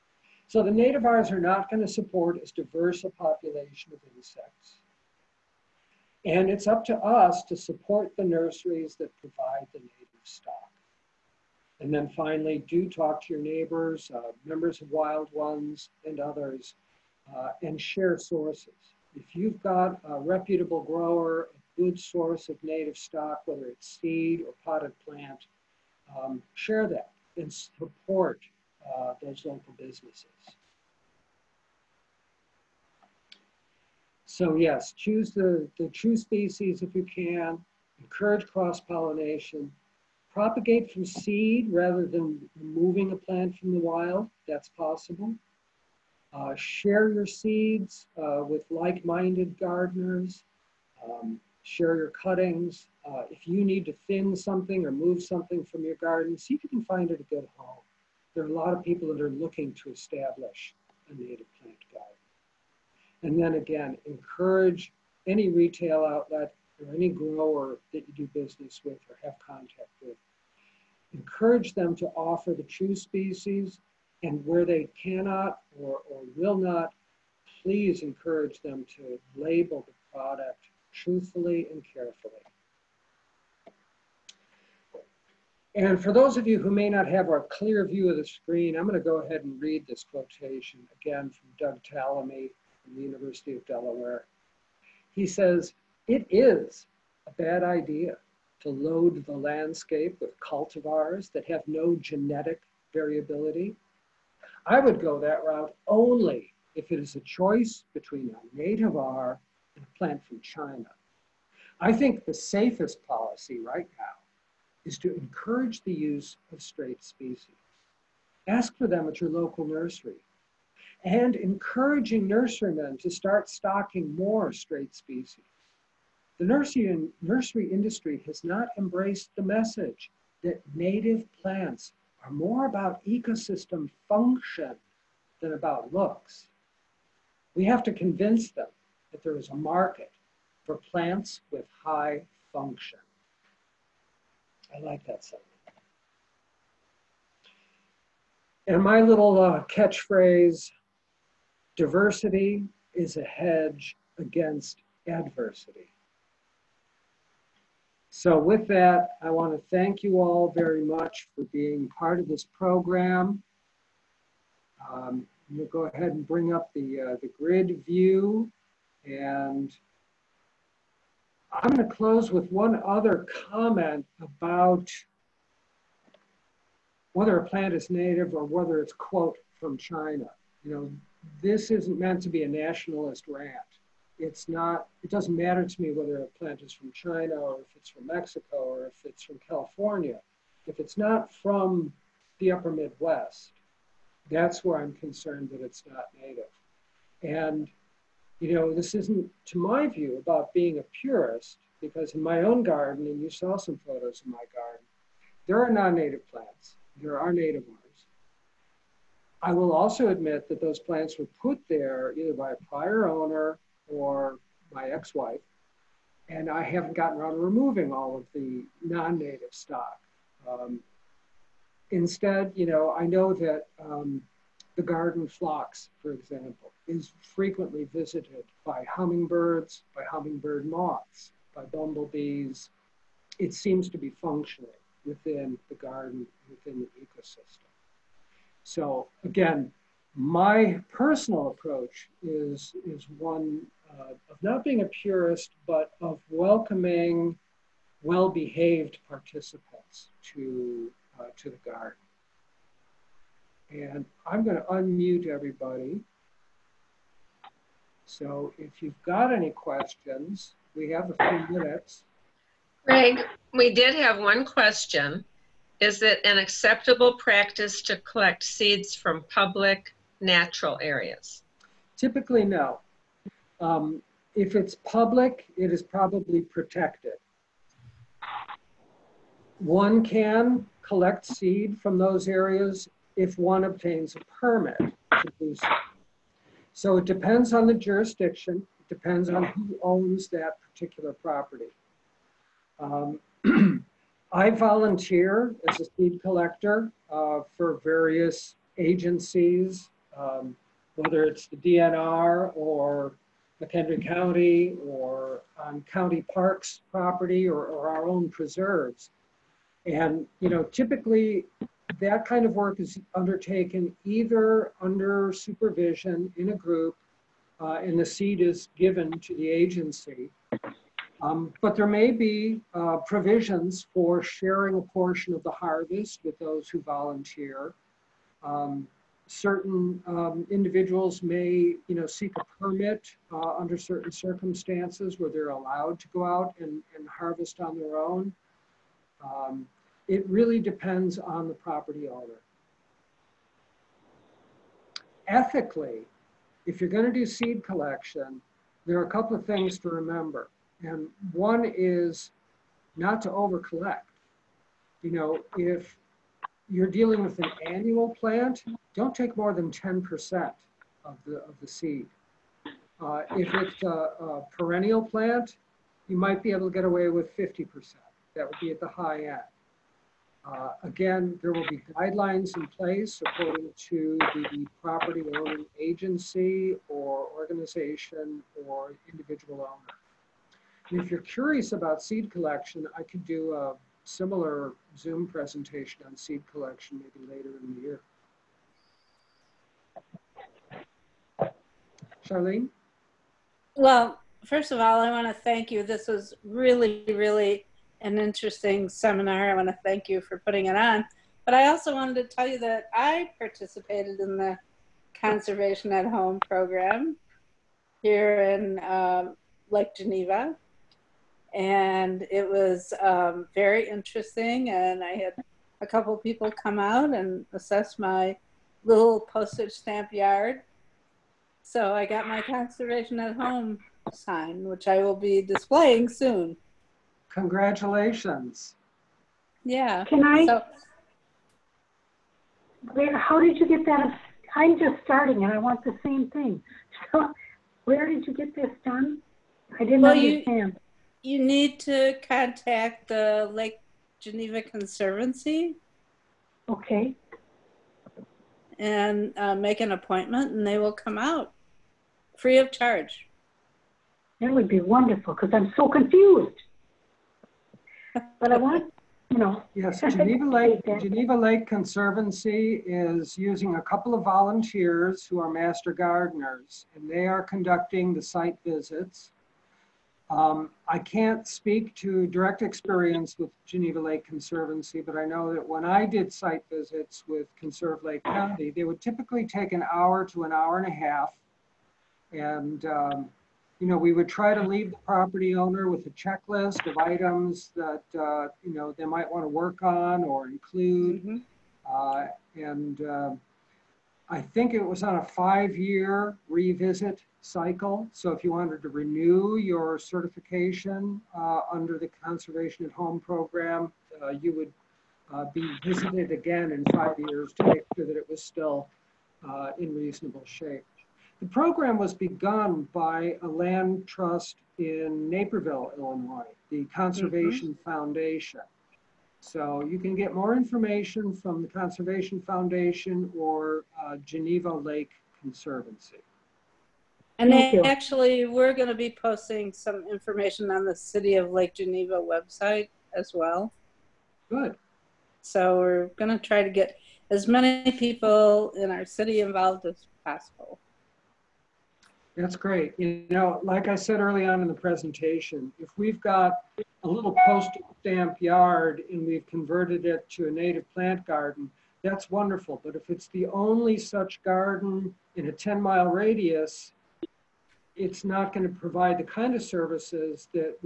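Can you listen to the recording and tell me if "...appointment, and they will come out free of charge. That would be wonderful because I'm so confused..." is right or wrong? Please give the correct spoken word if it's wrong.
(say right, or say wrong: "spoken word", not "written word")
right.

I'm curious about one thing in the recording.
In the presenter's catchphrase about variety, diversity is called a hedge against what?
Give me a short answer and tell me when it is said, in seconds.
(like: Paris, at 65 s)
adversity, at 155 s.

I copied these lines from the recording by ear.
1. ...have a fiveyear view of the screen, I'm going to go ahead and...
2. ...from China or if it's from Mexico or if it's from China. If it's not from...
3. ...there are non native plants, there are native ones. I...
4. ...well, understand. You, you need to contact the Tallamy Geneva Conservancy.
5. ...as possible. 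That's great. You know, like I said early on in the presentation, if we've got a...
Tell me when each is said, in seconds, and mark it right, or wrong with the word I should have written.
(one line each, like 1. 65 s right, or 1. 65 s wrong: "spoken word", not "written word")
1. 87 s wrong: "clear", not "fiveyear"
2. 186 s wrong: "California", not "China"
3. 205 s right
4. 440 s wrong: "Lake", not "Tallamy"
5. 539 s right.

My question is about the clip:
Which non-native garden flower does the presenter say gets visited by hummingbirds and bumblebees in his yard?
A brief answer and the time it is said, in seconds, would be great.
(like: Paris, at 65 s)
garden phlox, at 224 s.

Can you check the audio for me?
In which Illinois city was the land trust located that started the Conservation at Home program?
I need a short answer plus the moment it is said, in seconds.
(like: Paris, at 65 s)
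Naperville, at 515 s.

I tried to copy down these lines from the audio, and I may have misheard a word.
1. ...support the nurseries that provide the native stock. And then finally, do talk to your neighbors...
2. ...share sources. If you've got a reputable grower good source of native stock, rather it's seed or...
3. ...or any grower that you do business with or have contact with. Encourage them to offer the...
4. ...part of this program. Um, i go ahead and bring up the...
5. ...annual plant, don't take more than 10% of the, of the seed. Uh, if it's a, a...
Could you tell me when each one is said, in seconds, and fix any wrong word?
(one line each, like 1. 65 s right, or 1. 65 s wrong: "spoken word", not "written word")
1. 7 s right
2. 17 s wrong: "whether", not "rather"
3. 66 s right
4. 161 s right
5. 357 s right.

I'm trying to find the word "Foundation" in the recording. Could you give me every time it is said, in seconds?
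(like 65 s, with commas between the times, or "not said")
517 s, 522 s.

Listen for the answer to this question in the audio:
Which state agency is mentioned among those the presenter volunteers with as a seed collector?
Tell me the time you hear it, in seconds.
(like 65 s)
301 s.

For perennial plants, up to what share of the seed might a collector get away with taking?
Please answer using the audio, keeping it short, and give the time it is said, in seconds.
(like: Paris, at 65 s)
50%, at 367 s.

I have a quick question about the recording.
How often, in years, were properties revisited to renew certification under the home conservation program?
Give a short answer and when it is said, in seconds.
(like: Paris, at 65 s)
5, at 495 s.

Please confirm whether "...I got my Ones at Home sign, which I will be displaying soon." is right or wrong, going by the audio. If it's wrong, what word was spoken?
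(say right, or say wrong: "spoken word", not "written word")
wrong: "Conservation", not "Ones".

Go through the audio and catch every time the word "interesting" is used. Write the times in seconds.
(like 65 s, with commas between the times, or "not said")
398 s, 413 s.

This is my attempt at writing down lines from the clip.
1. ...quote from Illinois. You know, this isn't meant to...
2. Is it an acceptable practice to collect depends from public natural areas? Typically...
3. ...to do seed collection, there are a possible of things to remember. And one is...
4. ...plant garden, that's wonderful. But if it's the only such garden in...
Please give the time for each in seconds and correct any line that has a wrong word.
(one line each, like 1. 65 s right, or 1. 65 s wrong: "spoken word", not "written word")
1. 178 s wrong: "China", not "Illinois"
2. 265 s wrong: "seeds", not "depends"
3. 347 s wrong: "couple", not "possible"
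4. 550 s right.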